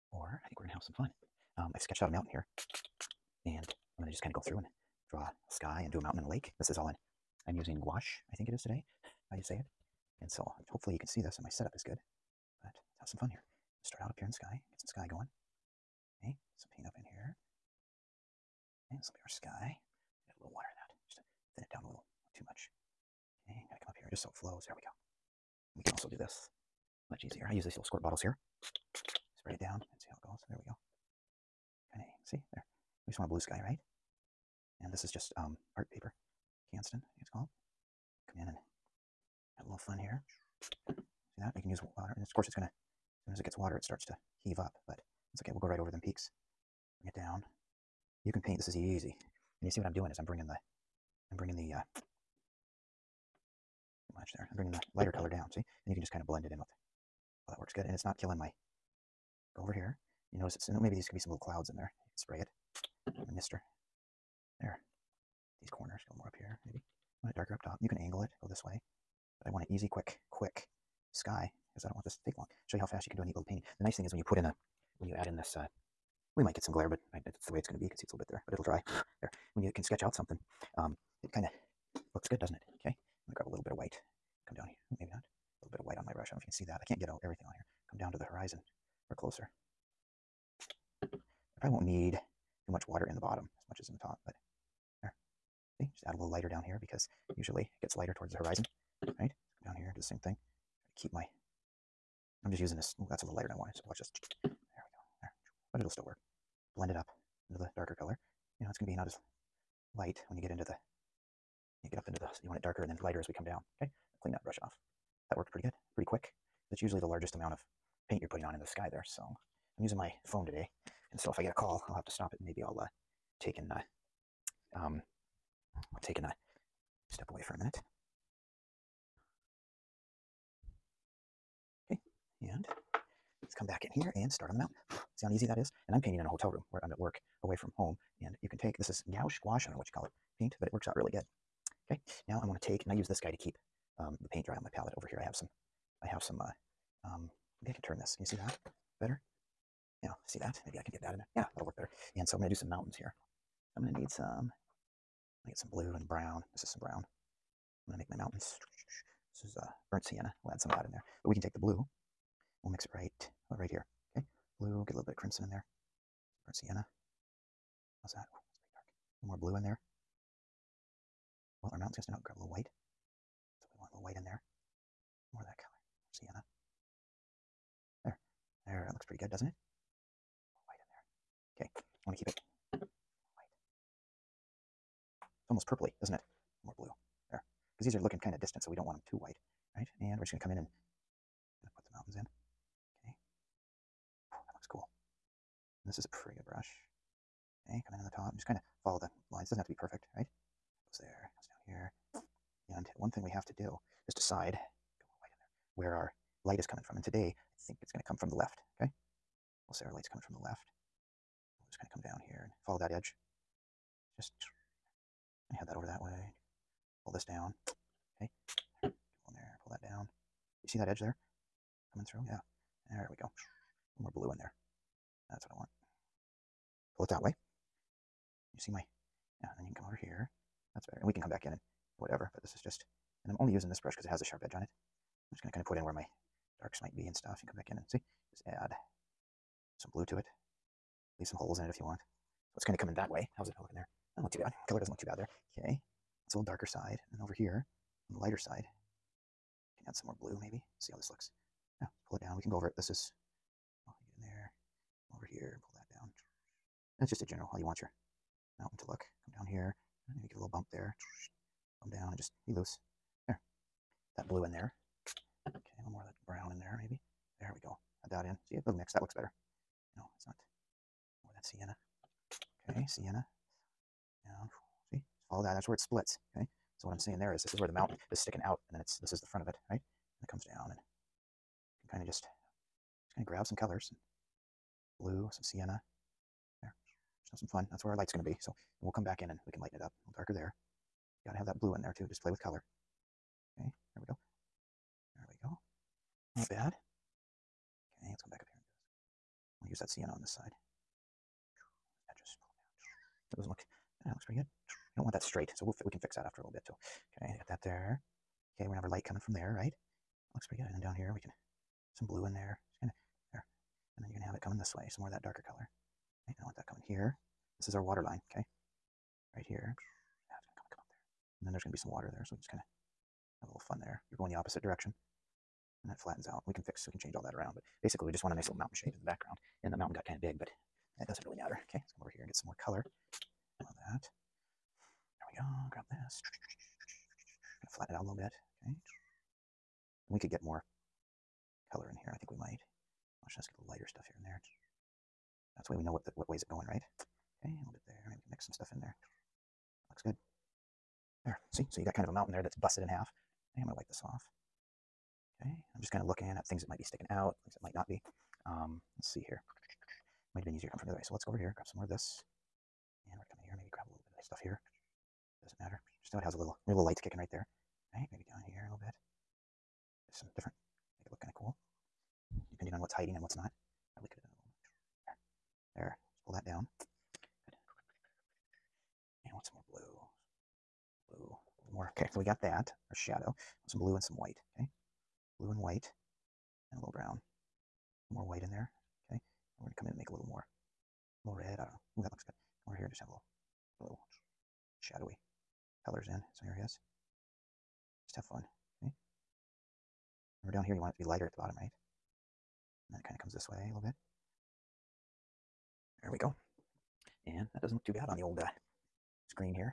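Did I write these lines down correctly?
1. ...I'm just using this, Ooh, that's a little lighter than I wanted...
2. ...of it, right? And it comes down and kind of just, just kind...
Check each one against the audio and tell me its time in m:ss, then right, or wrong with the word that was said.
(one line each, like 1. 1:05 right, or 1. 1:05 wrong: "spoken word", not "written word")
1. 1:42 right
2. 4:39 right.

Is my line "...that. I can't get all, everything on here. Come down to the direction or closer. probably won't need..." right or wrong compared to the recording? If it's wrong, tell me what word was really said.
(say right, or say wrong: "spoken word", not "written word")
wrong: "horizon", not "direction".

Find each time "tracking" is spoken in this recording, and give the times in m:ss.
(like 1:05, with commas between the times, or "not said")
not said.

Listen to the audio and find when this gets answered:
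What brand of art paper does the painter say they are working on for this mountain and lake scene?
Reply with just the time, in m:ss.
0:36.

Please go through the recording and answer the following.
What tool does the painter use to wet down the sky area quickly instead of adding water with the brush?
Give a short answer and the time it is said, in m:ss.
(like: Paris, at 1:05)
squirt bottles, at 0:27.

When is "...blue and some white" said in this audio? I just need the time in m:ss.
6:23.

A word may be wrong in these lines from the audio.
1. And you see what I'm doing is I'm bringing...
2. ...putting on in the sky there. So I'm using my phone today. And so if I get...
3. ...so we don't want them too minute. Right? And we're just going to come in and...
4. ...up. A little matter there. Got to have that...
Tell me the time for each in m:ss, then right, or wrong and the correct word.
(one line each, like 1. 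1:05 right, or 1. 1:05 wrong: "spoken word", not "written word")
1. 0:49 right
2. 1:58 right
3. 3:08 wrong: "white", not "minute"
4. 4:49 wrong: "darker", not "matter".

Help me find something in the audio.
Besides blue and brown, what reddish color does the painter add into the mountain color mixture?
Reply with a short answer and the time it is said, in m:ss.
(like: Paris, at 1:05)
crimson, at 2:45.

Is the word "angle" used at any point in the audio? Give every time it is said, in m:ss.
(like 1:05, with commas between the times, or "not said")
1:07.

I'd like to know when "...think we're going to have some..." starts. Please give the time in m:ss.
0:00.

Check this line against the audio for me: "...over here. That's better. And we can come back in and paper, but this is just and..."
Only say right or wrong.
wrong.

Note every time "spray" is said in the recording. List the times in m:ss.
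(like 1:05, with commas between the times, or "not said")
0:29, 1:02.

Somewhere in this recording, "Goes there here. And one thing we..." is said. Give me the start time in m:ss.
3:20.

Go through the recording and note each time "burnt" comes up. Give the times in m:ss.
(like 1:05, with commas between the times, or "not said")
2:39, 2:46.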